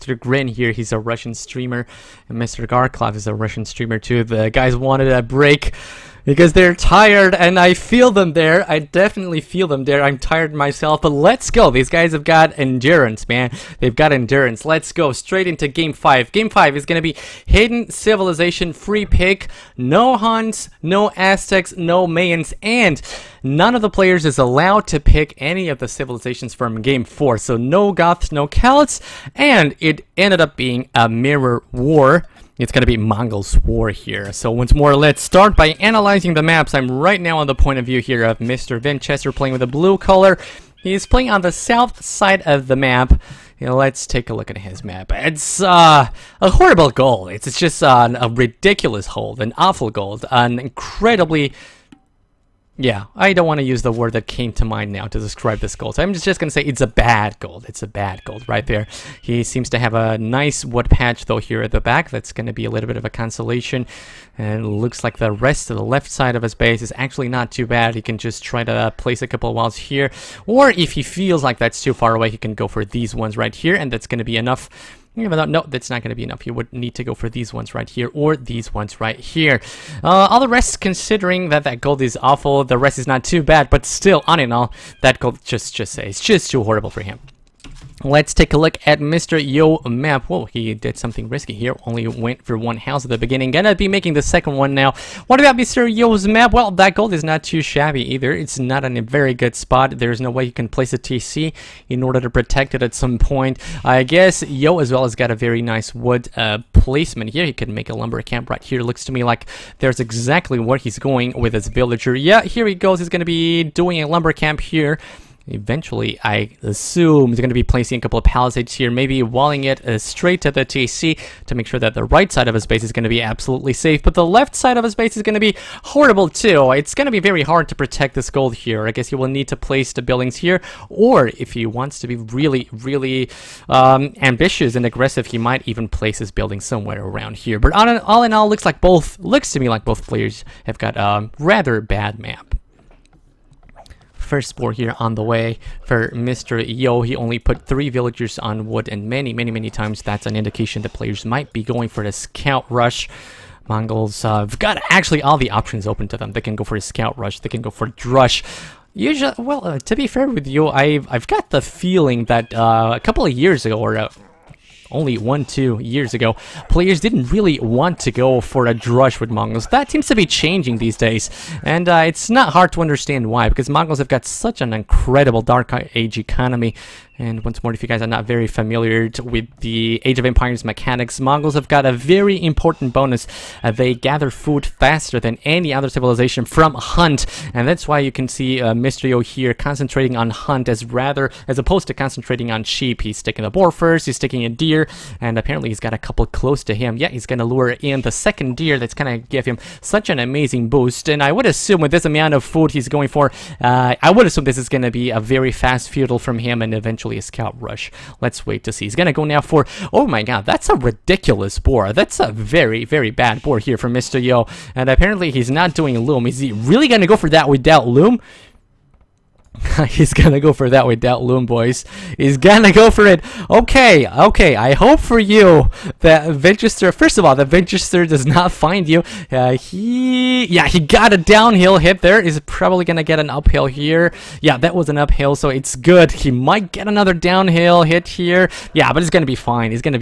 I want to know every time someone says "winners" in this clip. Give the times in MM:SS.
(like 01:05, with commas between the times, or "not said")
not said.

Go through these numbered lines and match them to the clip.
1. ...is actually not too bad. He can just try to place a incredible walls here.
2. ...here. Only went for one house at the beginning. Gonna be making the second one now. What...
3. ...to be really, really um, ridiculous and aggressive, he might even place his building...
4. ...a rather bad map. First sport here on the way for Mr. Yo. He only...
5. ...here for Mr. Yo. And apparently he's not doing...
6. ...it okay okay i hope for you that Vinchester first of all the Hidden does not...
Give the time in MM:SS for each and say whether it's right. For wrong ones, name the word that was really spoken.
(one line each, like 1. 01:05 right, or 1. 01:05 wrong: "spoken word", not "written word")
1. 01:06 wrong: "couple", not "incredible"
2. 01:31 right
3. 02:11 wrong: "ambitious", not "ridiculous"
4. 02:20 right
5. 03:33 right
6. 03:43 wrong: "Vinchester", not "Hidden".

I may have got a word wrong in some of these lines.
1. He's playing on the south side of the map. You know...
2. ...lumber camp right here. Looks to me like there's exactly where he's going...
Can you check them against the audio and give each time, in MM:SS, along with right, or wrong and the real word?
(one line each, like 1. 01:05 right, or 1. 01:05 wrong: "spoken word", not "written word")
1. 00:40 right
2. 01:47 right.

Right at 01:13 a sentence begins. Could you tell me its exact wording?
And that's going to be enough no, that's not going to be enough.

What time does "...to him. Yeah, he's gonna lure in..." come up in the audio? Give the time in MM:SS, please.
03:16.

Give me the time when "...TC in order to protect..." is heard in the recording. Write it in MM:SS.
01:40.